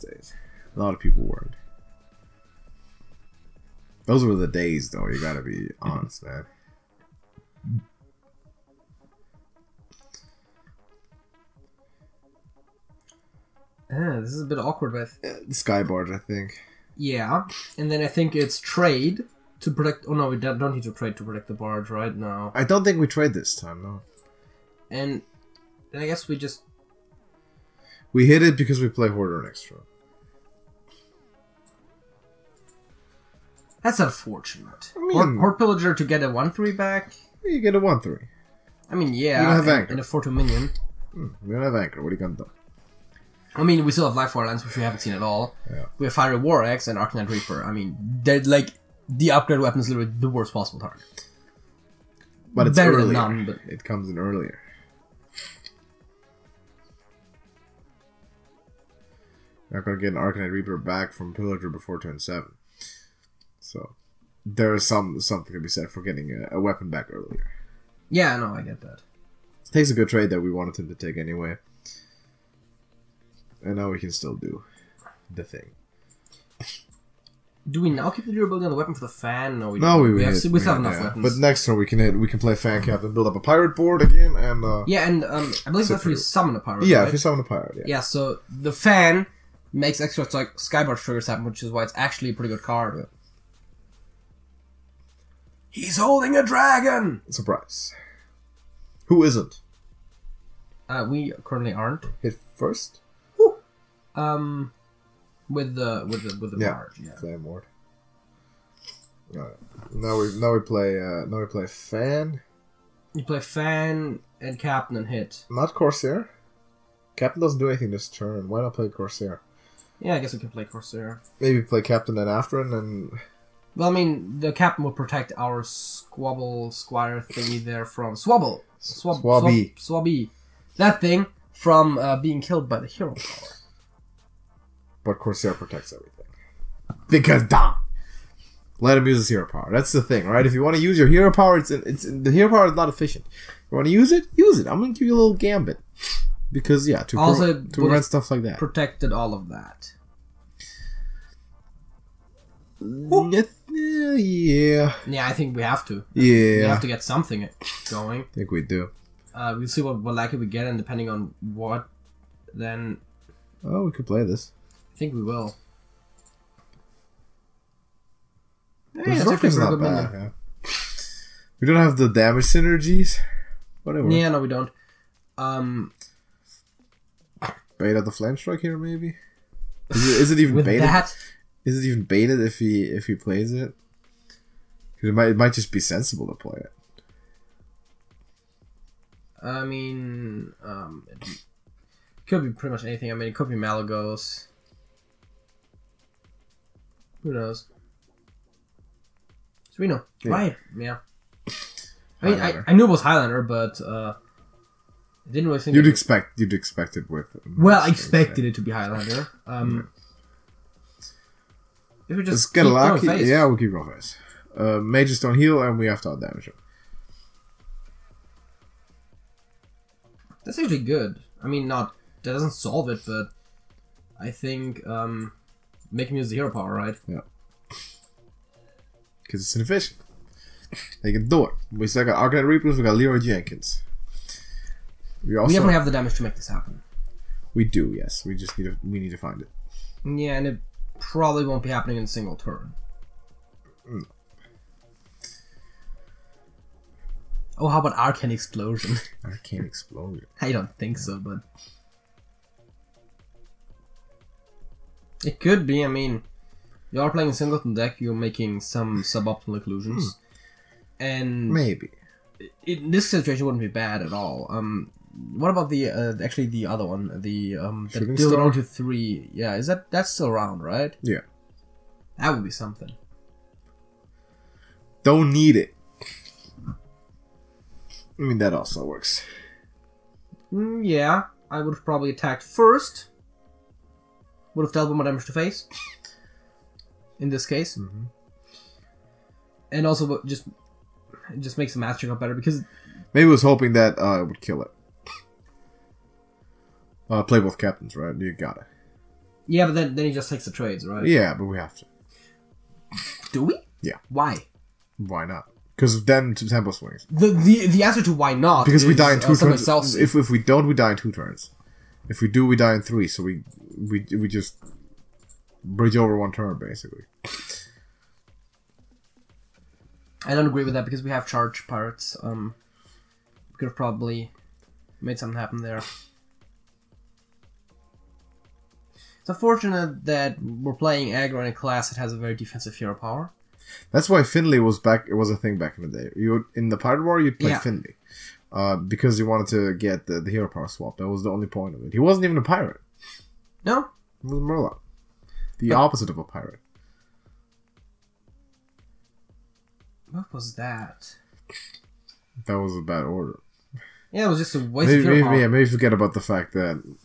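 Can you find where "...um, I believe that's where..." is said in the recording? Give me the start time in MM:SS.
01:25.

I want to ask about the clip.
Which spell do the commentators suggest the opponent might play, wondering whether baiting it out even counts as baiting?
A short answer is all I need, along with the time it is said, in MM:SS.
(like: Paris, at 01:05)
Flame Strike, at 02:58.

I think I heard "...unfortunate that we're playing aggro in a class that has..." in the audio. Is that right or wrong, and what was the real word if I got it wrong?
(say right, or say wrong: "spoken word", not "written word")
right.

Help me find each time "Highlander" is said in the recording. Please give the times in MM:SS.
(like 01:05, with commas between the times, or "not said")
03:23, 03:28.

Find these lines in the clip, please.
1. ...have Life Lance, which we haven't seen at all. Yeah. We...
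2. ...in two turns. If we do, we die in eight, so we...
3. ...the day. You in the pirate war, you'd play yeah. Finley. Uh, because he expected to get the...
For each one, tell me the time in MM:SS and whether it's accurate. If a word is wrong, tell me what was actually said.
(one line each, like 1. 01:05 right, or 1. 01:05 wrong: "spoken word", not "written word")
1. 00:44 right
2. 05:10 wrong: "three", not "eight"
3. 05:35 wrong: "wanted", not "expected".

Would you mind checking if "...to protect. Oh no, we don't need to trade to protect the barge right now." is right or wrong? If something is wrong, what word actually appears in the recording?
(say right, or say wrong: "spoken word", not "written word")
right.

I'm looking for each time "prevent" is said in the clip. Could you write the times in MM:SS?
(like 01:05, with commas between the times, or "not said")
02:27.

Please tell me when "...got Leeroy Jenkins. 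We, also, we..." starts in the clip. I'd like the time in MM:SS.
03:52.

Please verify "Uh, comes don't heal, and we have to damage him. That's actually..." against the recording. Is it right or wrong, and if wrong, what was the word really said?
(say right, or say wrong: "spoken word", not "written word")
wrong: "mages", not "comes".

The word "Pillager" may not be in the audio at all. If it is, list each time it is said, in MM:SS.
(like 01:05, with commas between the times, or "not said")
00:35, 01:01.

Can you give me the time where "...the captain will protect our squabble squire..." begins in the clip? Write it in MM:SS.
02:04.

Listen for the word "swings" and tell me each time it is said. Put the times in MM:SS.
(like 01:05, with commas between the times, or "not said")
05:06.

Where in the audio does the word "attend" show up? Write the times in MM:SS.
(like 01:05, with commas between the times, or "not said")
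not said.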